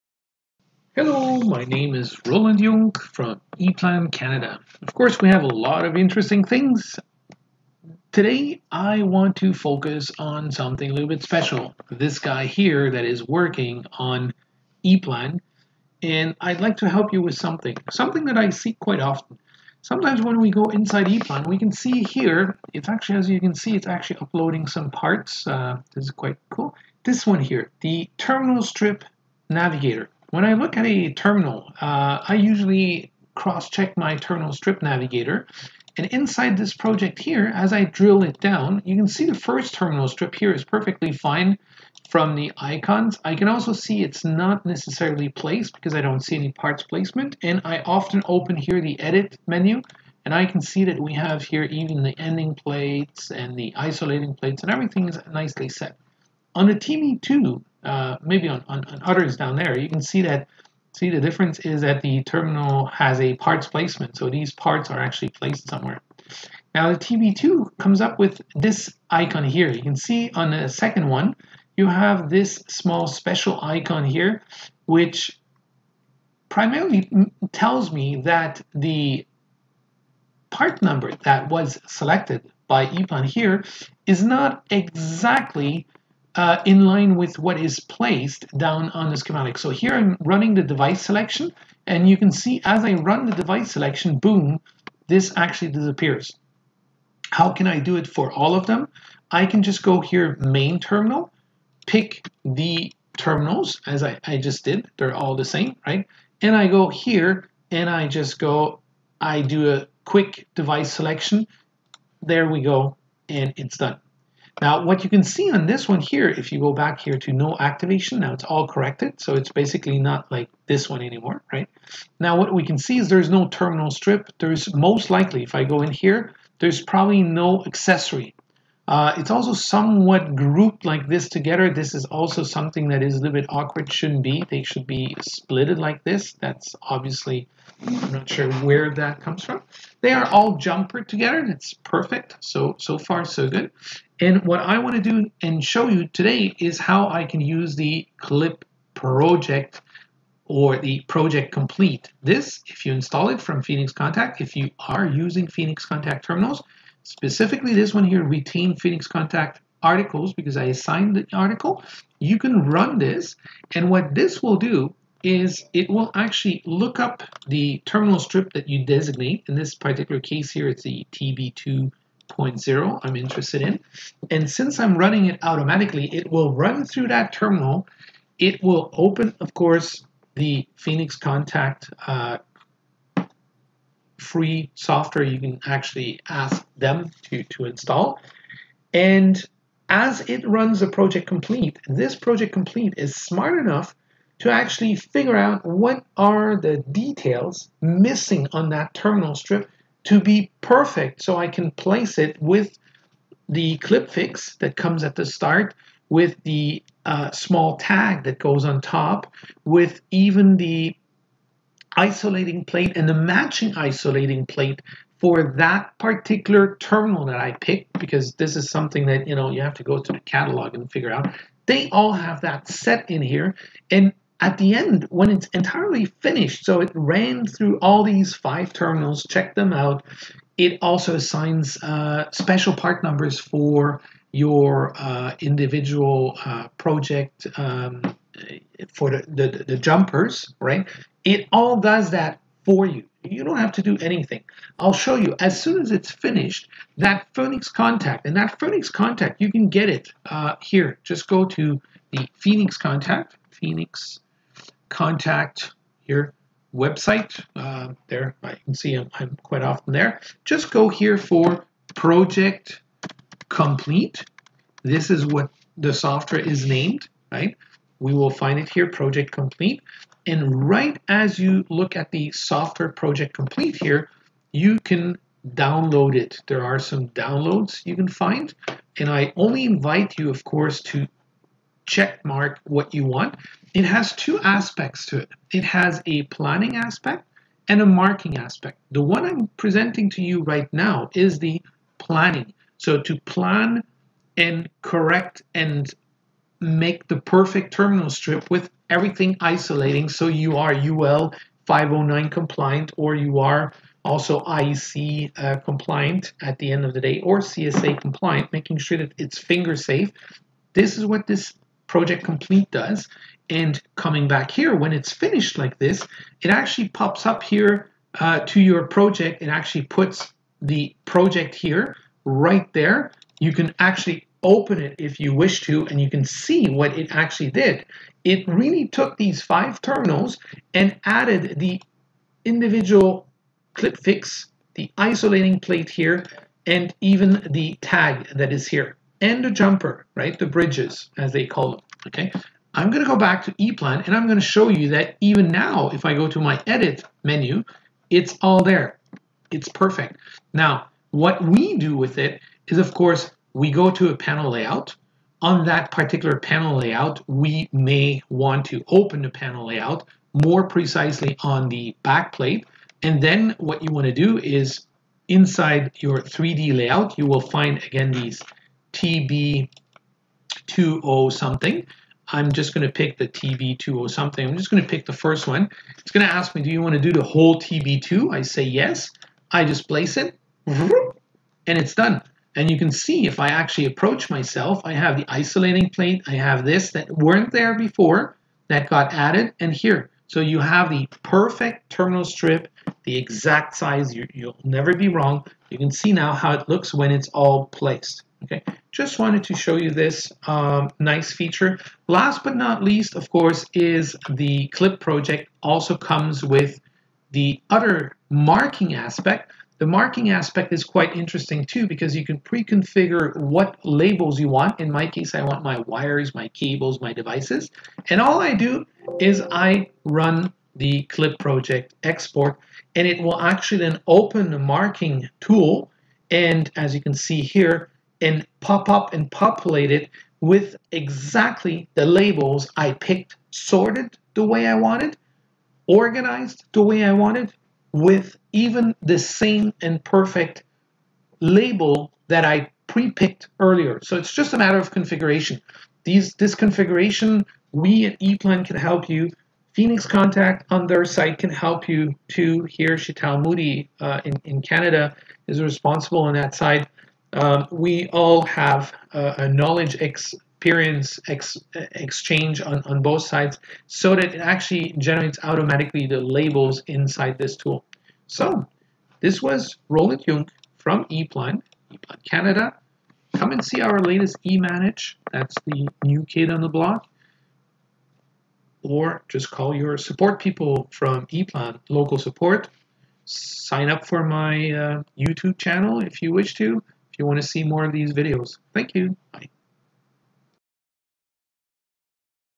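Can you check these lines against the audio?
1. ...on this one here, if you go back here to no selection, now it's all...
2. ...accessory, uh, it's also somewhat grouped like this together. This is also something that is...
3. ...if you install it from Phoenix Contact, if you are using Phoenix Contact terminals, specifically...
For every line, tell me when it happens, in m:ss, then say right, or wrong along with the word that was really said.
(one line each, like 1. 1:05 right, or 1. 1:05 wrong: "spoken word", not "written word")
1. 1:55 wrong: "activation", not "selection"
2. 2:07 right
3. 2:32 right.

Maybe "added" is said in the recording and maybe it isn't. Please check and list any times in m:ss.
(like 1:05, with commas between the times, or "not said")
5:31, 6:29.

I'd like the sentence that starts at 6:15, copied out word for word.
It's going to ask me, do you want to do the whole TB2?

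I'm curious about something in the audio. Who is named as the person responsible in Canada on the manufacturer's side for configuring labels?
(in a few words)
Shital Moody.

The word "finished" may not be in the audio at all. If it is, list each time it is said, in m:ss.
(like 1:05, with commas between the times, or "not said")
3:46, 4:06, 5:15.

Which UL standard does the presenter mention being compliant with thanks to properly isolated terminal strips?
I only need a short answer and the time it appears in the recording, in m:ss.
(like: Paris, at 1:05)
UL 509, at 5:00.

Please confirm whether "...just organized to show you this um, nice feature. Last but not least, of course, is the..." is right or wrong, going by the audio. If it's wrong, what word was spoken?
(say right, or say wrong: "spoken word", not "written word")
wrong: "wanted", not "organized".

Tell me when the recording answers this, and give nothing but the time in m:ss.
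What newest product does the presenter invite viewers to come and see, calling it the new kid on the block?
7:54.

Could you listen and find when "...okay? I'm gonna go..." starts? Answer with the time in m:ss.
5:42.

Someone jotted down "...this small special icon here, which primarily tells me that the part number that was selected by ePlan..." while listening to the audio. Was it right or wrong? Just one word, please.
right.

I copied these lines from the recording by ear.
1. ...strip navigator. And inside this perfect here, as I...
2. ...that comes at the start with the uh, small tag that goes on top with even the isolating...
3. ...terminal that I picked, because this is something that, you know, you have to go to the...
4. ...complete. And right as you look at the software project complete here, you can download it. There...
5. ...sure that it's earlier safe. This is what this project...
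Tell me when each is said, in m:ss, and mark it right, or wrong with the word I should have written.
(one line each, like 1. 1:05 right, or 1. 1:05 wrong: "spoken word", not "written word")
1. 0:34 wrong: "project", not "perfect"
2. 3:24 right
3. 3:36 right
4. 4:29 right
5. 5:08 wrong: "finger", not "earlier".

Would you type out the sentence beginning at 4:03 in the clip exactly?
You don't have to do anything.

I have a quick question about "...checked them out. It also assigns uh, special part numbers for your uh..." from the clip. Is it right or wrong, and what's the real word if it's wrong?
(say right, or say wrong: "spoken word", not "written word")
right.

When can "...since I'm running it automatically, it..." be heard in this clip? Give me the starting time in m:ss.
2:54.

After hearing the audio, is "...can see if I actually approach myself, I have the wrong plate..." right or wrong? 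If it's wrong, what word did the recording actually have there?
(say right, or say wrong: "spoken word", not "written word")
wrong: "isolating", not "wrong".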